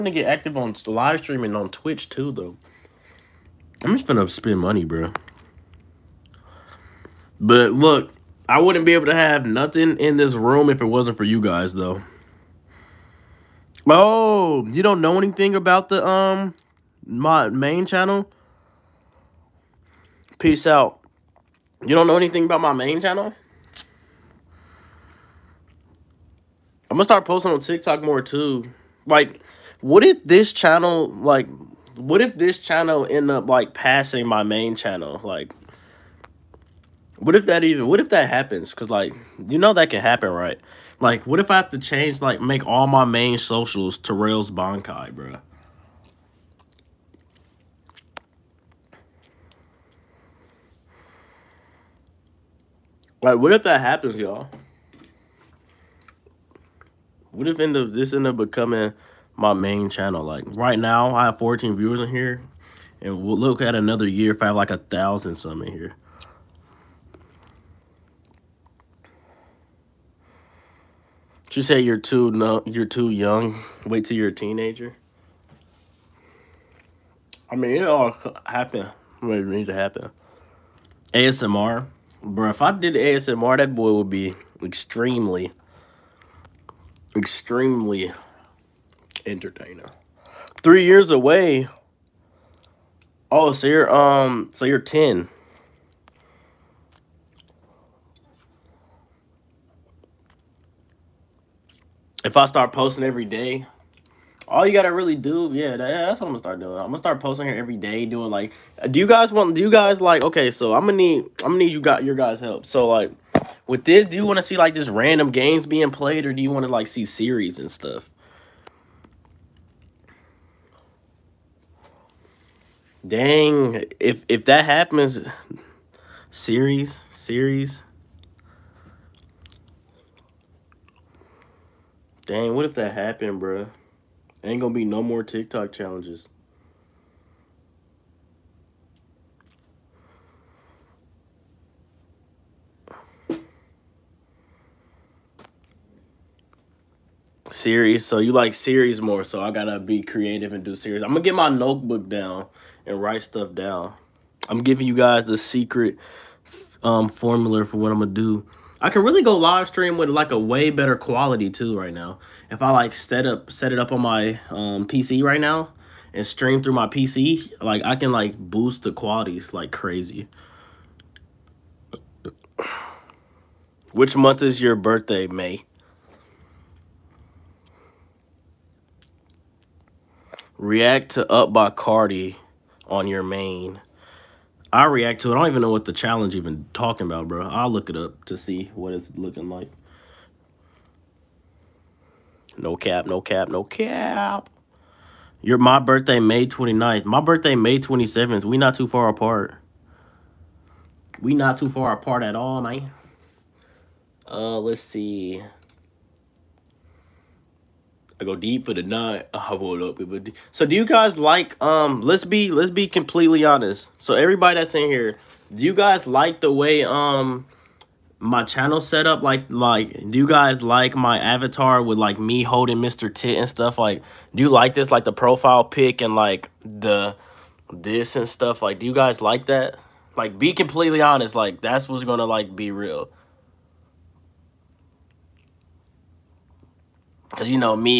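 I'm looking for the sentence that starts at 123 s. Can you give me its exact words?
Dang, if if that happens, series, series.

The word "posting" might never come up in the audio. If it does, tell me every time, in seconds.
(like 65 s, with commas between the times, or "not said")
27 s, 102 s, 107 s.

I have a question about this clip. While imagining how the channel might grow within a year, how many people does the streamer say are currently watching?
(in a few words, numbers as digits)
14.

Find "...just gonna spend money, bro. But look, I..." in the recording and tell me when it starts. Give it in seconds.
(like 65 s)
3 s.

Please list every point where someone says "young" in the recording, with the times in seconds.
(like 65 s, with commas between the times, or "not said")
73 s.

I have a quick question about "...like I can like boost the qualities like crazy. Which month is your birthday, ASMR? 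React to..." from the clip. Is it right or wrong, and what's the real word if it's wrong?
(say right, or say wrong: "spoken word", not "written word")
wrong: "May", not "ASMR".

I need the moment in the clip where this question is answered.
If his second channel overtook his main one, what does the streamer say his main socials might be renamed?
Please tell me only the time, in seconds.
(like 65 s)
44 s.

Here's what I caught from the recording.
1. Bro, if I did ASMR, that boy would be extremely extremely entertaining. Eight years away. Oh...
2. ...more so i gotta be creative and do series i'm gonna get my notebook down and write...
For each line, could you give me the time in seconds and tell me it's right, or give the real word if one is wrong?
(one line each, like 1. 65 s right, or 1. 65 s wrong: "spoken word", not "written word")
1. 82 s wrong: "Three", not "Eight"
2. 149 s right.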